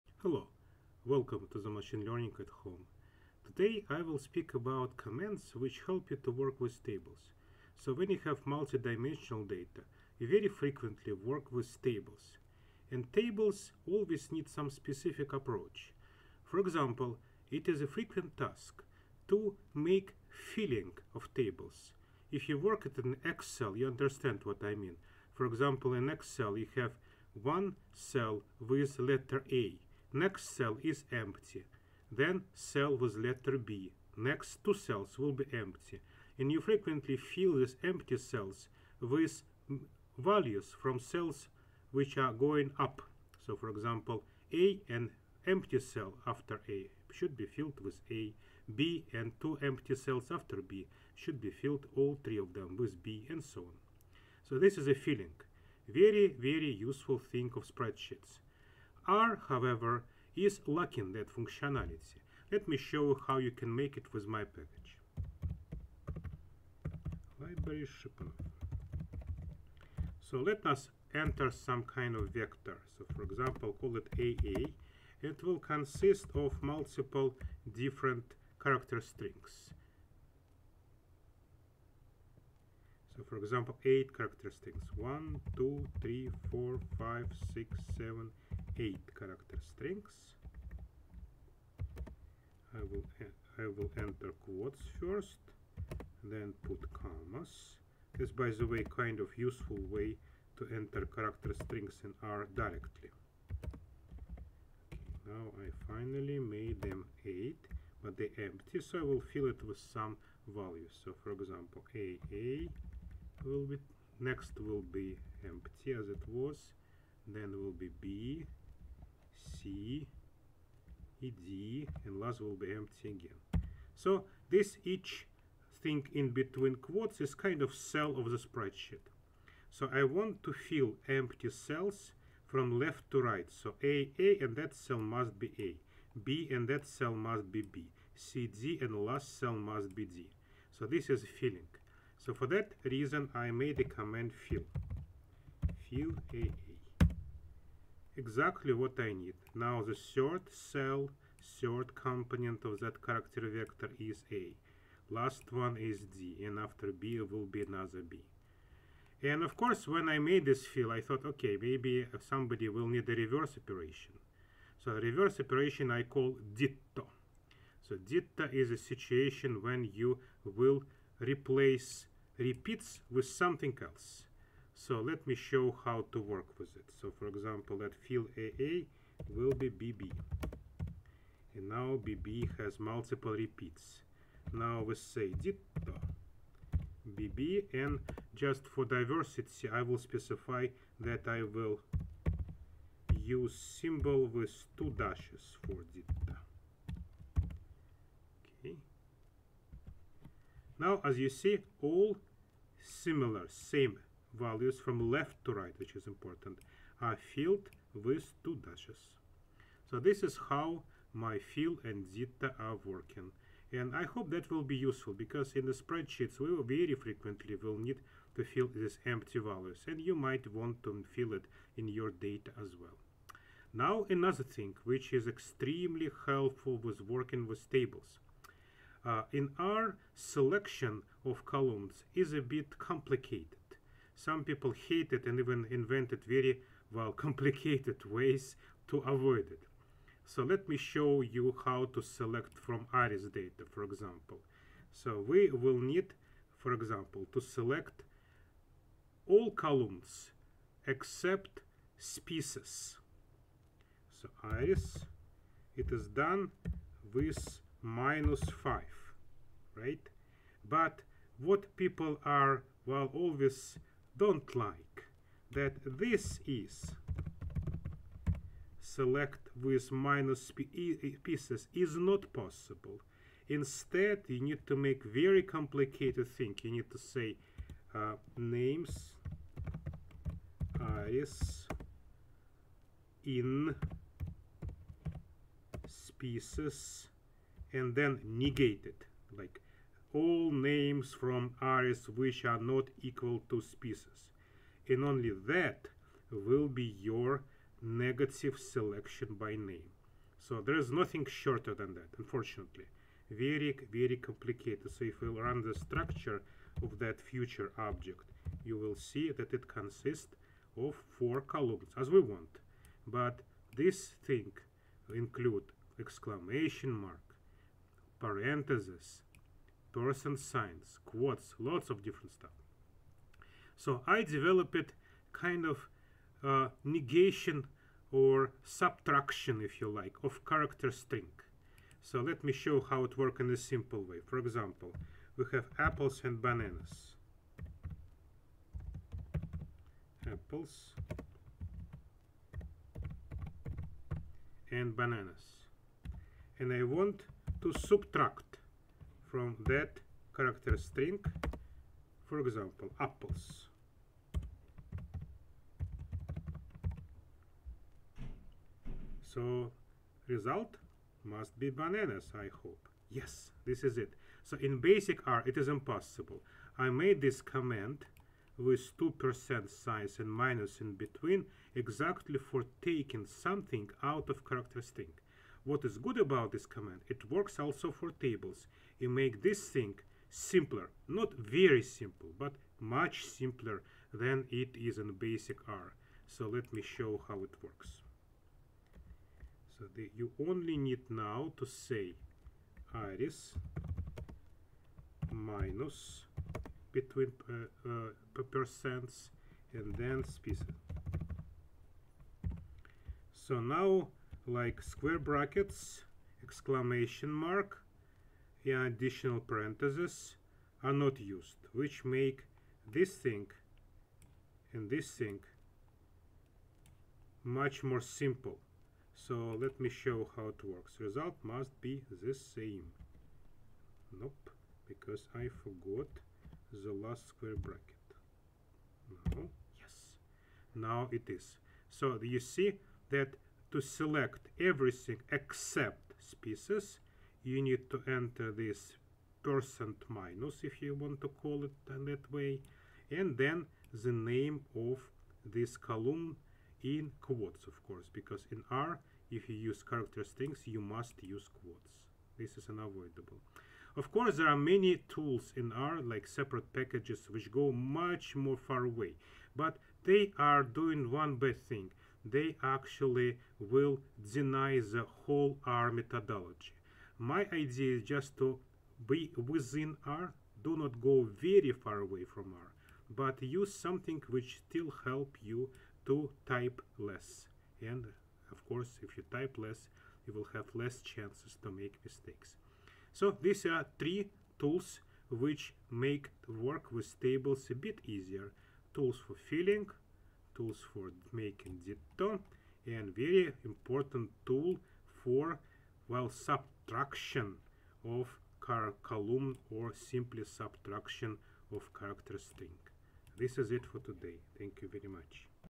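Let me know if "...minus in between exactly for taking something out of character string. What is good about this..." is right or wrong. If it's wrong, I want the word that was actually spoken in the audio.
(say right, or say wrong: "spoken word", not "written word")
right.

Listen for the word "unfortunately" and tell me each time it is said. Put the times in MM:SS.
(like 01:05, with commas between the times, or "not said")
05:02.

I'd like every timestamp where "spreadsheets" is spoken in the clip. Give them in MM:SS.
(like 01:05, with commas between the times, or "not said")
00:57, 02:08, 03:35.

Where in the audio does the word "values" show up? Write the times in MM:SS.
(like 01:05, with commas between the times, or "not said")
00:40, 01:50, 03:24, 03:39.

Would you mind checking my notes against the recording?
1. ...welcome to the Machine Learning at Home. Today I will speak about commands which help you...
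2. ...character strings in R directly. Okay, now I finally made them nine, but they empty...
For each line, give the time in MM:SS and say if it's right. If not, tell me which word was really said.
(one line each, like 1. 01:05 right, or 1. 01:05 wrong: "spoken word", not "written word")
1. 00:01 right
2. 01:41 wrong: "eight", not "nine".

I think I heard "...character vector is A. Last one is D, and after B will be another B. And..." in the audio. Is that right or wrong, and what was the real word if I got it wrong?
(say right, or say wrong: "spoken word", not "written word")
right.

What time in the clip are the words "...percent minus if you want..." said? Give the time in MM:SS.
07:19.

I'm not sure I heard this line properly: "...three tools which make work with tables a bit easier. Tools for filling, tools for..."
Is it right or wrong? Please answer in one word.
right.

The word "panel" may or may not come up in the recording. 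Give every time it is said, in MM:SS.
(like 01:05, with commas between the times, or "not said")
not said.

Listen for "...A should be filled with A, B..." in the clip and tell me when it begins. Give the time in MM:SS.
00:46.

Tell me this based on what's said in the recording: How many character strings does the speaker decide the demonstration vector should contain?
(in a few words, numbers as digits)
8.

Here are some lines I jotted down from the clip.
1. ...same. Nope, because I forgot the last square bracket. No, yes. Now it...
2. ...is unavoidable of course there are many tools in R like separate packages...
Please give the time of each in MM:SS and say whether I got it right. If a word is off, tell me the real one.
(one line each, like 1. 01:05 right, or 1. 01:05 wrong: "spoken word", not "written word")
1. 07:02 right
2. 07:32 right.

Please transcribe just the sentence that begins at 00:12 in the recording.
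And tables always need some specific approach.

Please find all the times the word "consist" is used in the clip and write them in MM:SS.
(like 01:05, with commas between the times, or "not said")
01:15, 05:09.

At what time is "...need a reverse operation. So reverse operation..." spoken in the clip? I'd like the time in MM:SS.
02:42.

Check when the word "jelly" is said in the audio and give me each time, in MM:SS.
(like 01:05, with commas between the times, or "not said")
not said.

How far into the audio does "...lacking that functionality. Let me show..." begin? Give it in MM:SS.
01:00.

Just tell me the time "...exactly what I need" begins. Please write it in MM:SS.
02:28.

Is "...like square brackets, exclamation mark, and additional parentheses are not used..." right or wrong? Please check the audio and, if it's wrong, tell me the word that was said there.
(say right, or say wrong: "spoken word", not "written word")
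right.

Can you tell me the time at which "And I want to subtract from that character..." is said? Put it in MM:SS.
05:46.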